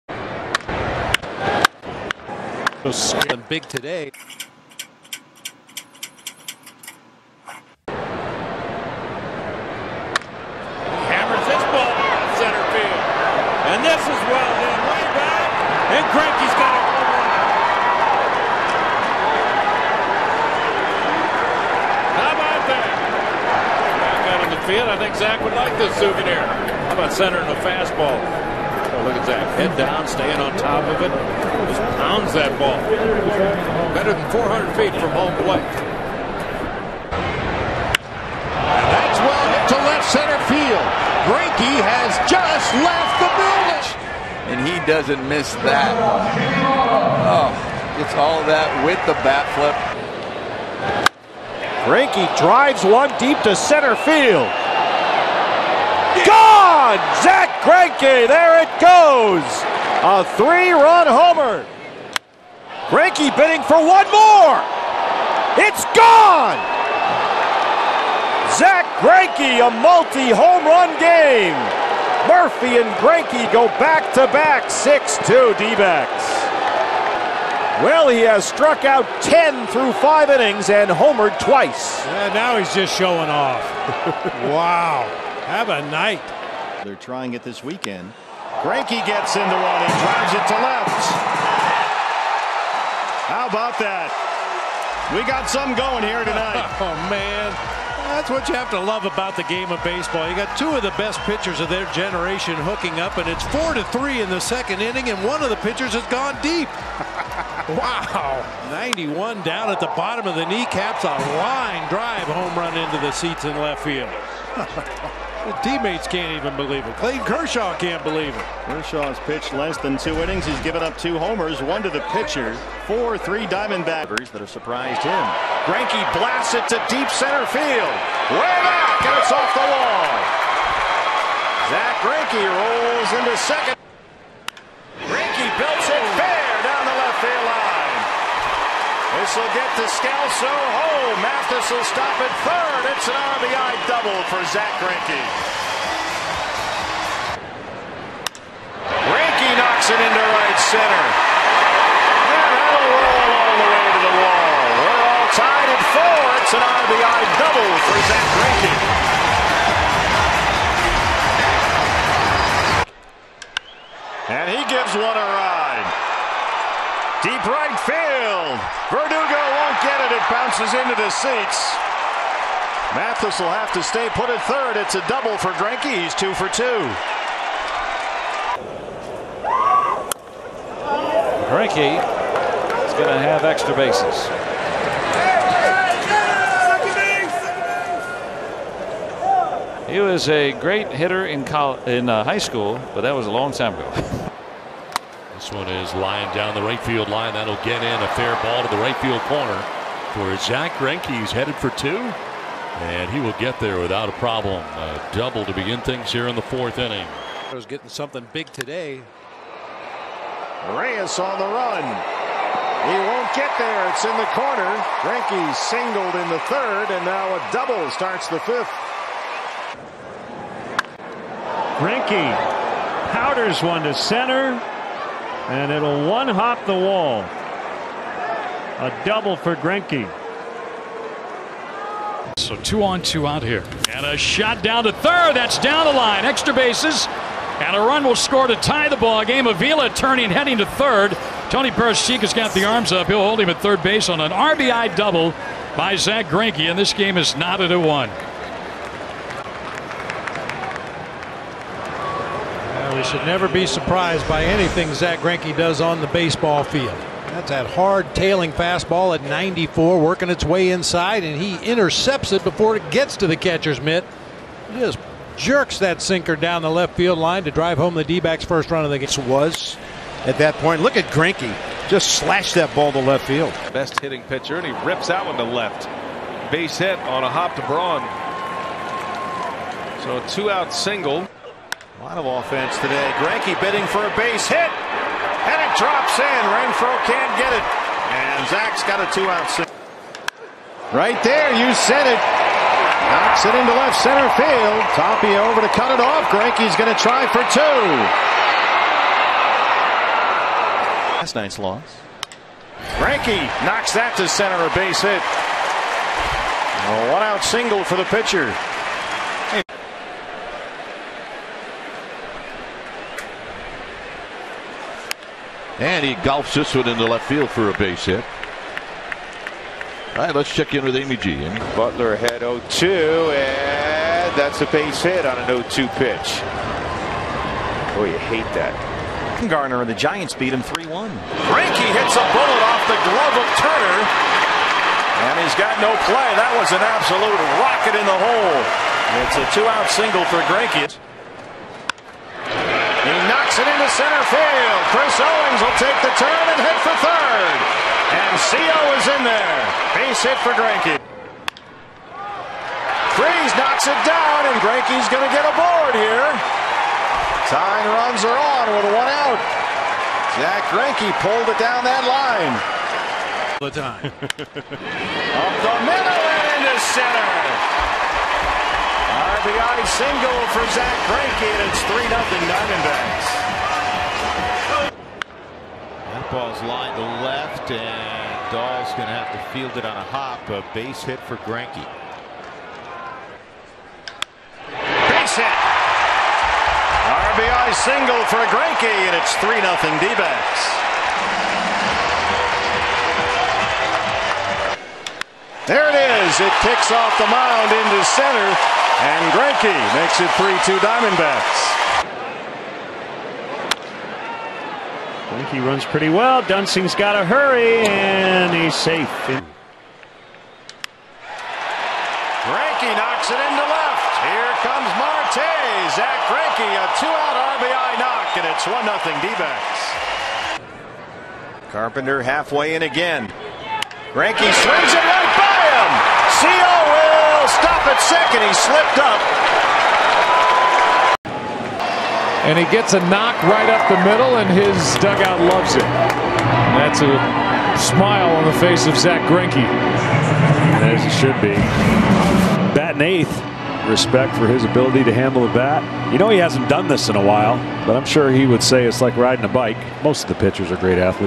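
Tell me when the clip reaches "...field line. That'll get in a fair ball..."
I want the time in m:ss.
3:16.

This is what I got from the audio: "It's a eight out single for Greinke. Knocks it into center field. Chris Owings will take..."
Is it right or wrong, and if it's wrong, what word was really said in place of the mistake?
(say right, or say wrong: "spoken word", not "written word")
wrong: "two", not "eight".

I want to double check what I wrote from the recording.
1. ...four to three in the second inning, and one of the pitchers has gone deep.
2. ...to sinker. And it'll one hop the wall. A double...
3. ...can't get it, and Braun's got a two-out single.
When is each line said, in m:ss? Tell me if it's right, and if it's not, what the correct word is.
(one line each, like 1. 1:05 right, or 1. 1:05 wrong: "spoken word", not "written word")
1. 1:43 right
2. 3:43 wrong: "center", not "sinker"
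3. 4:47 wrong: "Zack", not "Braun".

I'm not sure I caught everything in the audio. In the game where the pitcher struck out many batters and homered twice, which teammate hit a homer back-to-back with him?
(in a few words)
Murphy.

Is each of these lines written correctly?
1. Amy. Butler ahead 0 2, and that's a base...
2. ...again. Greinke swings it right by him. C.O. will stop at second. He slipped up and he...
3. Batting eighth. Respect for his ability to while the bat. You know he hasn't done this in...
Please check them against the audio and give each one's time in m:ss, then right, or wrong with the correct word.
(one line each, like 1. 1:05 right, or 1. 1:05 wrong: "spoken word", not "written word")
1. 5:21 right
2. 7:02 right
3. 7:22 wrong: "handle", not "while".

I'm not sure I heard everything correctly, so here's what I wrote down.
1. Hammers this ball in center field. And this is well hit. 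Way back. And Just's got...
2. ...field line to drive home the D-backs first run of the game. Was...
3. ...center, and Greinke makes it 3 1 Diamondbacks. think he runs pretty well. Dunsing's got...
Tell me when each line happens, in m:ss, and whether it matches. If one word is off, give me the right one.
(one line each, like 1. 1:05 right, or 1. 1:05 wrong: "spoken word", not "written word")
1. 0:11 wrong: "Greinke", not "Just"
2. 4:26 right
3. 6:38 wrong: "2", not "1".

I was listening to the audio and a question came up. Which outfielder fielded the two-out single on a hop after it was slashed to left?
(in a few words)
Braun.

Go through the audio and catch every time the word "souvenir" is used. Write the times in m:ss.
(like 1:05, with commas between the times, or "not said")
0:25.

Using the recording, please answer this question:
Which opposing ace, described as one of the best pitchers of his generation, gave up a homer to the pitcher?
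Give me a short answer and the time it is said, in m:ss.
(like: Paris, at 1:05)
Clayton Kershaw, at 1:56.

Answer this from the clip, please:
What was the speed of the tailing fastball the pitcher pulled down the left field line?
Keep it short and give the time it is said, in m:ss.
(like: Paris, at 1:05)
94, at 4:19.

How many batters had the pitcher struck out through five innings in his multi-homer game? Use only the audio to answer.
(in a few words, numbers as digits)
10.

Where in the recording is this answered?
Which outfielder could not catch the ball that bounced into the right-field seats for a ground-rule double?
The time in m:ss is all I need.
2:48.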